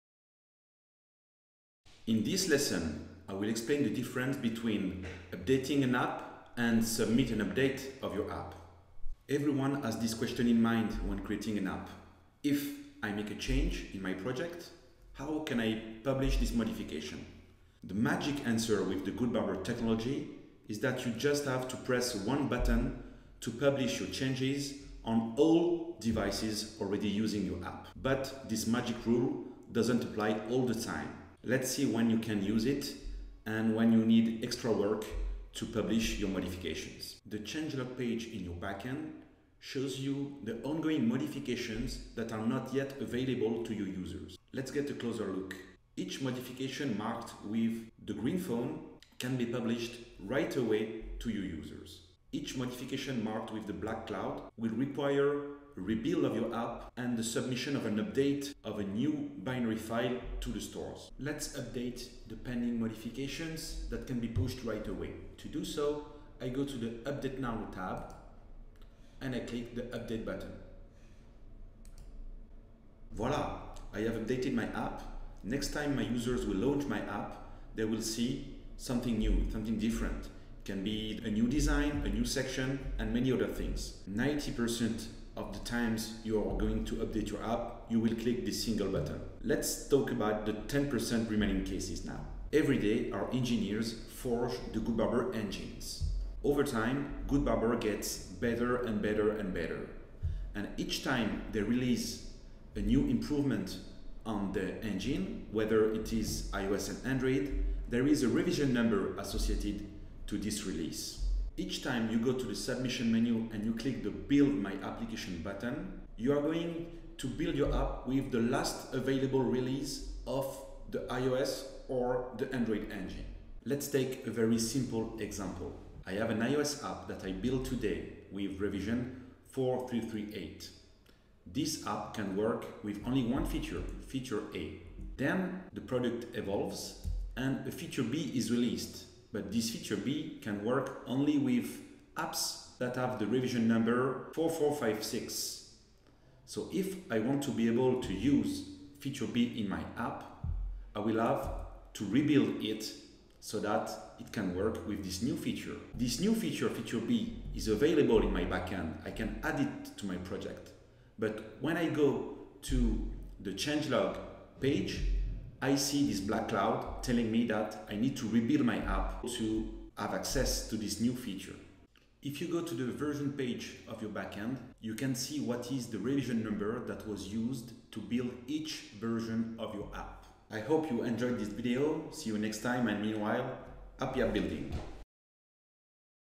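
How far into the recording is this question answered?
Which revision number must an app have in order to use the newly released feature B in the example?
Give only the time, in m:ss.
2:24.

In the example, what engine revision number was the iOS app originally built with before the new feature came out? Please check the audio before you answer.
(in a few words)
4338.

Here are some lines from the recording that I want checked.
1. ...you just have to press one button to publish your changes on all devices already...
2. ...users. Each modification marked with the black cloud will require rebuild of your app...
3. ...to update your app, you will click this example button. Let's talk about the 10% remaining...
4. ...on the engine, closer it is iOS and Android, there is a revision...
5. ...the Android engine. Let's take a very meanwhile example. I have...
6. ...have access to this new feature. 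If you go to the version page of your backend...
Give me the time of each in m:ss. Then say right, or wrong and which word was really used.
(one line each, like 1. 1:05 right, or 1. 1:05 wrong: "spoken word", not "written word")
1. 0:21 right
2. 0:51 right
3. 1:26 wrong: "single", not "example"
4. 1:44 wrong: "whether", not "closer"
5. 2:02 wrong: "simple", not "meanwhile"
6. 2:49 right.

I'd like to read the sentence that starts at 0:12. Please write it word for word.
If I make a change in my project, how can I publish this modification?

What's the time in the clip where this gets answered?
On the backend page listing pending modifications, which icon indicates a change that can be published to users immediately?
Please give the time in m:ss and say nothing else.
0:48.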